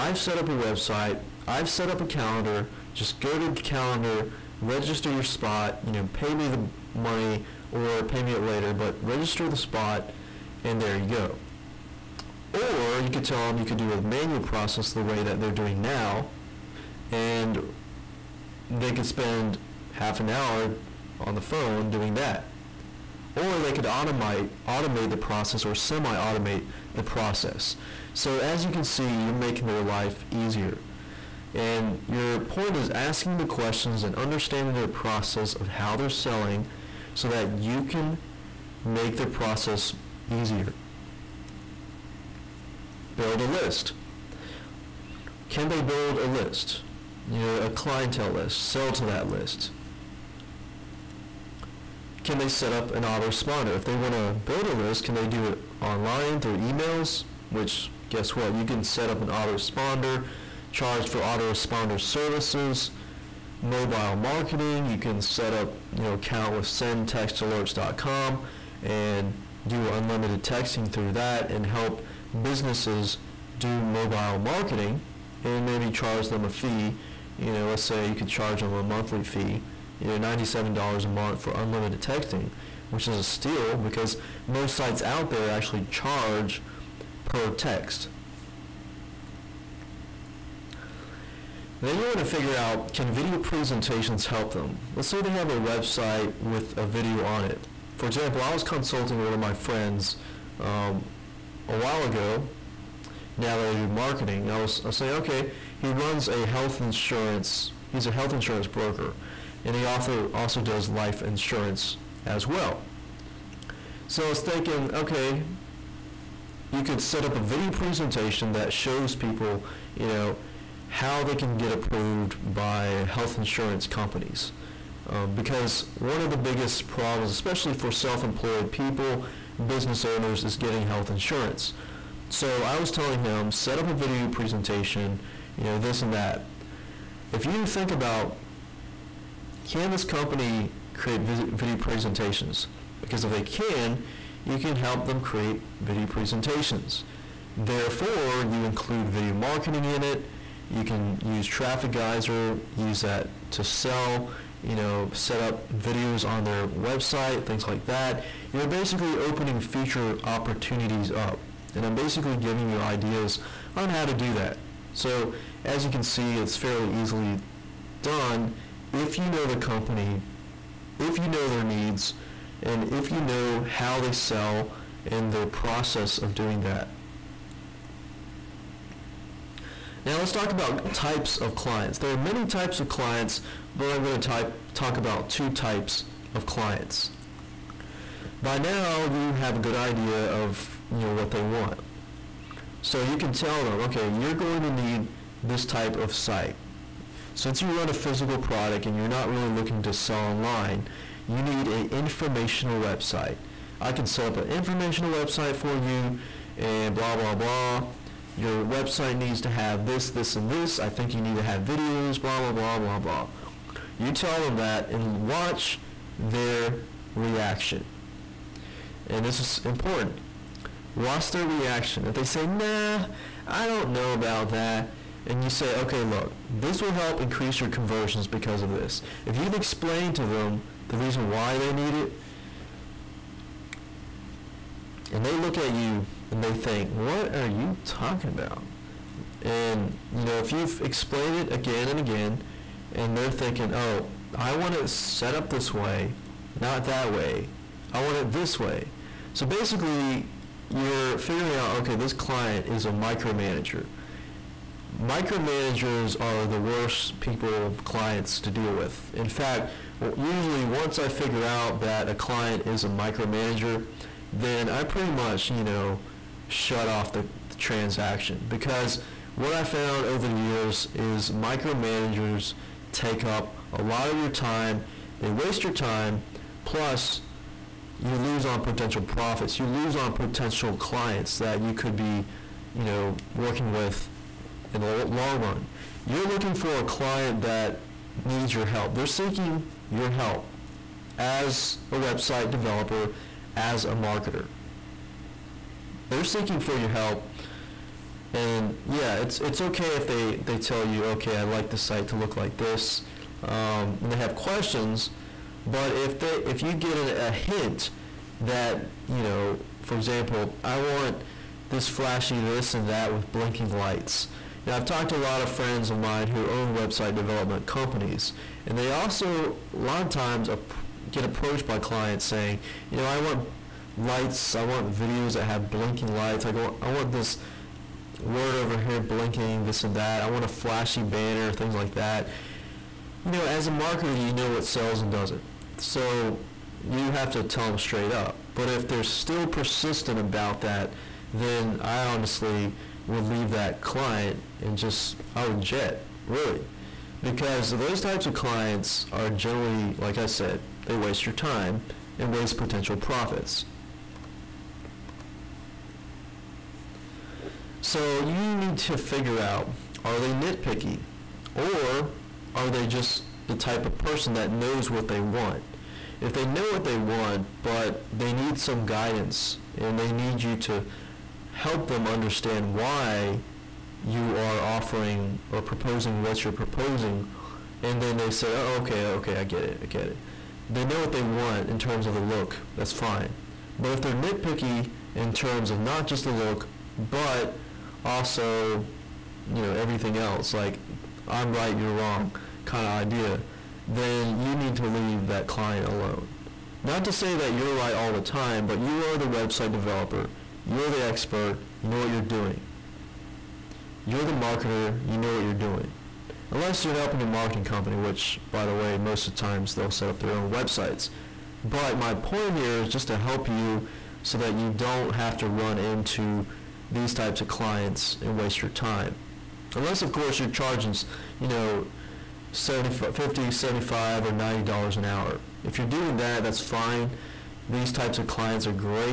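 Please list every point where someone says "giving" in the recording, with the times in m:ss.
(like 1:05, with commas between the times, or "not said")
2:42.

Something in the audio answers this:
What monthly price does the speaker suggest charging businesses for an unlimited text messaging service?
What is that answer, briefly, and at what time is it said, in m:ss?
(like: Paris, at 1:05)
$97, at 1:20.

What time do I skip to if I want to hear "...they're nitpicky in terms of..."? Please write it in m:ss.
6:24.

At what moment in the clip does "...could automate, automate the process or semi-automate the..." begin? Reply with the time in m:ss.
0:23.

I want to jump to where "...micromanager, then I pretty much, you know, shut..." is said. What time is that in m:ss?
4:22.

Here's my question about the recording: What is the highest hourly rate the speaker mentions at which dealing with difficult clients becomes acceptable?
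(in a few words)
$90 an hour.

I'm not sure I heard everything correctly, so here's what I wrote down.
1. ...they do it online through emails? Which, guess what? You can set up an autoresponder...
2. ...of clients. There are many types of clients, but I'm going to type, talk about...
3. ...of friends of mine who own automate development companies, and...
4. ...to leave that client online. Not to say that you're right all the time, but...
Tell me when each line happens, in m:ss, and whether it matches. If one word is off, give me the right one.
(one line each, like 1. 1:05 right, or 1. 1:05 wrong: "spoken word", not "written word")
1. 0:55 right
2. 3:01 right
3. 5:15 wrong: "website", not "automate"
4. 6:34 wrong: "alone", not "online".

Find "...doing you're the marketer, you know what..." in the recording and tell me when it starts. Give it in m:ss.
6:42.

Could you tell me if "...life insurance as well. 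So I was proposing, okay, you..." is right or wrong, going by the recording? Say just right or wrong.
wrong.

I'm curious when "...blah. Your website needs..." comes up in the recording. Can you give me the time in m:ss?
3:27.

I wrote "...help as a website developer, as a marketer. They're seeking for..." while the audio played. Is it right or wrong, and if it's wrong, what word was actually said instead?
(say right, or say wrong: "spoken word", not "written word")
right.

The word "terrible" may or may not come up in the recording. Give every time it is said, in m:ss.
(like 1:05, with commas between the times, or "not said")
not said.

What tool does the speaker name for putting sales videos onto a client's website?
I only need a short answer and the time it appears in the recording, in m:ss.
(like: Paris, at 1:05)
Trafficizor, at 2:31.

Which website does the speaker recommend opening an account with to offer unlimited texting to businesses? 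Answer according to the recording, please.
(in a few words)
sendtextalerts.com.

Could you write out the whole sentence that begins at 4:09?
So basically, you're figuring out, okay, this client is a micromanager micromanagers are the worst people clients to deal with.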